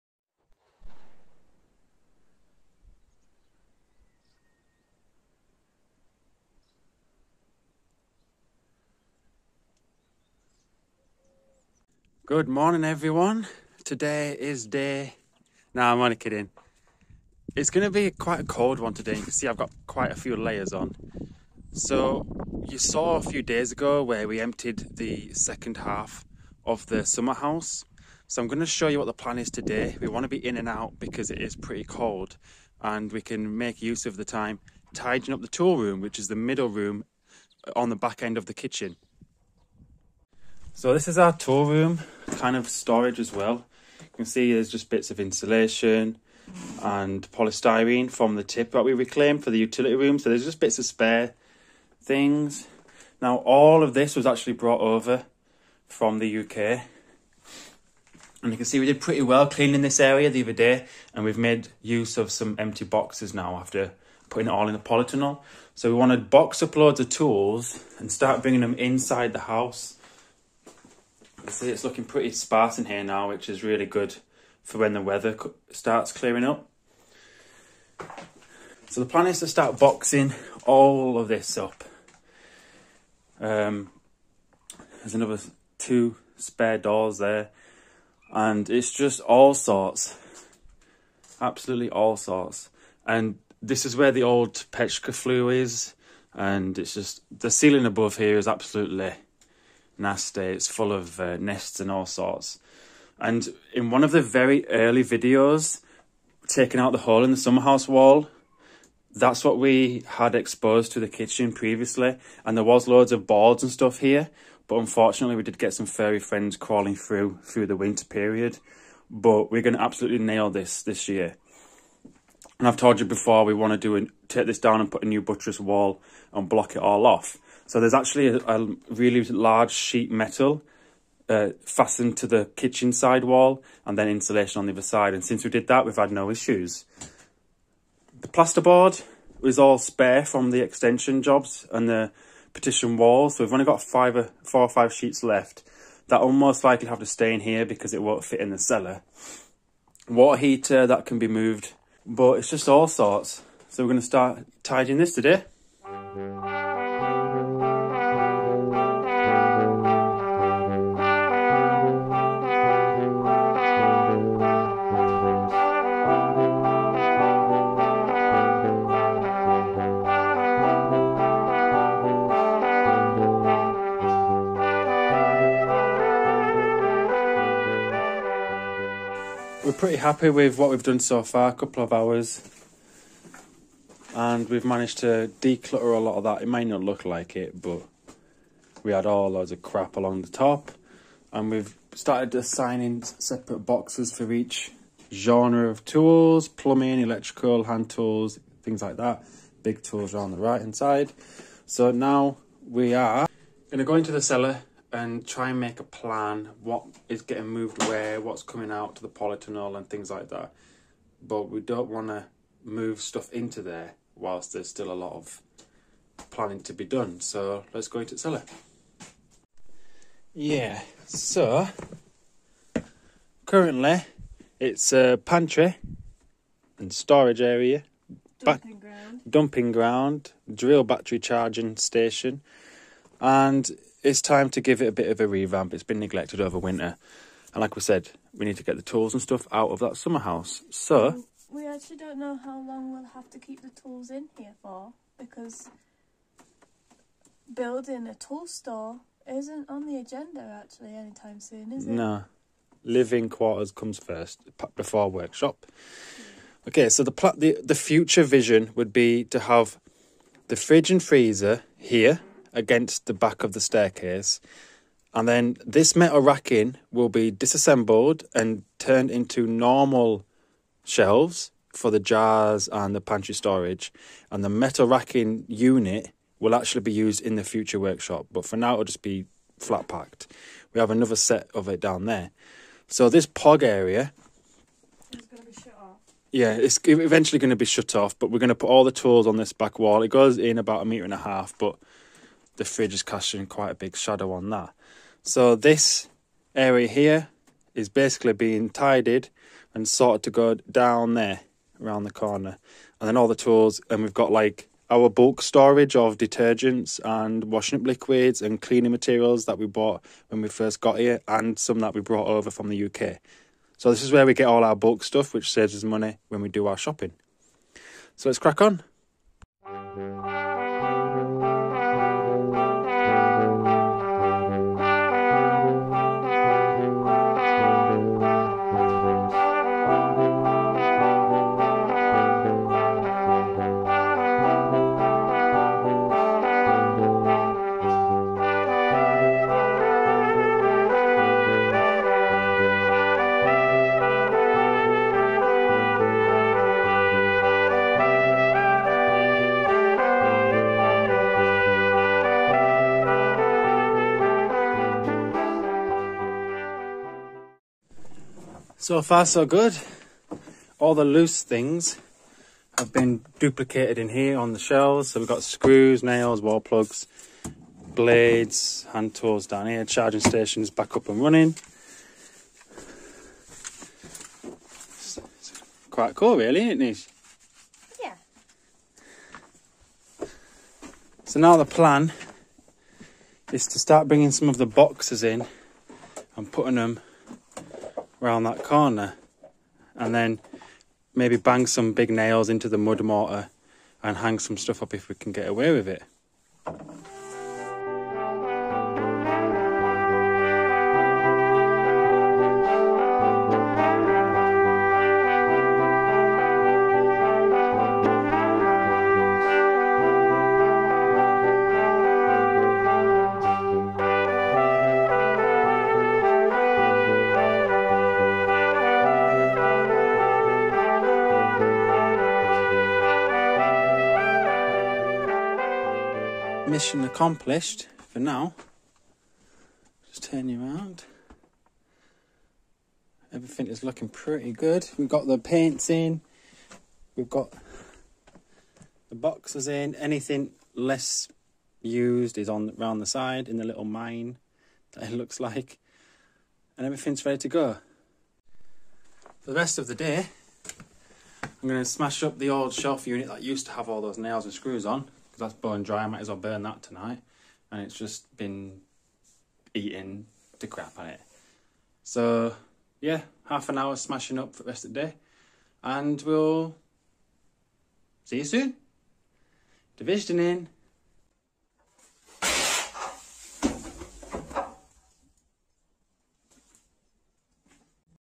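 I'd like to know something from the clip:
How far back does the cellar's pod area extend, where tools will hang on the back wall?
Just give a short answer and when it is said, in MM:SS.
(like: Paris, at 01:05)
a metre and a half, at 04:50.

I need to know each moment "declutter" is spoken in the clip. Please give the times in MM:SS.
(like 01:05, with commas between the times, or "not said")
03:05.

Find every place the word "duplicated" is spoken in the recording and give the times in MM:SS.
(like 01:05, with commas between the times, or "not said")
06:03.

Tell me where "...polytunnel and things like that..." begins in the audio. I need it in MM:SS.
03:29.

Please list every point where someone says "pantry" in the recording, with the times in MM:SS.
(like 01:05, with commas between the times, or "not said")
03:45, 04:33.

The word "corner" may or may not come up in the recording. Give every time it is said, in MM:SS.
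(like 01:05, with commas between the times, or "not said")
05:02, 06:28.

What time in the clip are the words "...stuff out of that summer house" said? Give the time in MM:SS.
03:59.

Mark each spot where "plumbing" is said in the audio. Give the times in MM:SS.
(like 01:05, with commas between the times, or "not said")
03:16.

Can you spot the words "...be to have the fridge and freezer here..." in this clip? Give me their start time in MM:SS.
04:18.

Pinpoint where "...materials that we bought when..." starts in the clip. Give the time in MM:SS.
05:08.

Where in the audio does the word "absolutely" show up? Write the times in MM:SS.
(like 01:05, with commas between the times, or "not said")
01:31, 01:38, 01:59.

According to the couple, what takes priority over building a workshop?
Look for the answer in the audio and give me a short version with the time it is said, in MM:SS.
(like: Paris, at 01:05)
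Living quarters, at 04:12.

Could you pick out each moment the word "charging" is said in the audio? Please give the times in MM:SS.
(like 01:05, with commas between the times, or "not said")
03:51, 06:09.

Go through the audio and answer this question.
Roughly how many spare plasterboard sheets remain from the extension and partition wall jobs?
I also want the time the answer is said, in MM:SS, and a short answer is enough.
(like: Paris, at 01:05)
4 or 5, at 02:24.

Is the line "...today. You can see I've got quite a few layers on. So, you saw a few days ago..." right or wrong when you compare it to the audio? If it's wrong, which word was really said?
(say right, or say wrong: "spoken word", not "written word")
right.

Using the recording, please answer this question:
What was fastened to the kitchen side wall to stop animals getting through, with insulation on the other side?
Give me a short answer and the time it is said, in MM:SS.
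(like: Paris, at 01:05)
sheet metal, at 02:09.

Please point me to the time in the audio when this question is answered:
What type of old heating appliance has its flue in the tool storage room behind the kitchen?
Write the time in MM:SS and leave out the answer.
01:34.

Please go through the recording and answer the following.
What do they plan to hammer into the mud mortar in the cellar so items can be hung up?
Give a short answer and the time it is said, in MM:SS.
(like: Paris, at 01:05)
big nails, at 06:31.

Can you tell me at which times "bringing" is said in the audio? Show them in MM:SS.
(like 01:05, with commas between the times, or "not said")
01:08, 06:24.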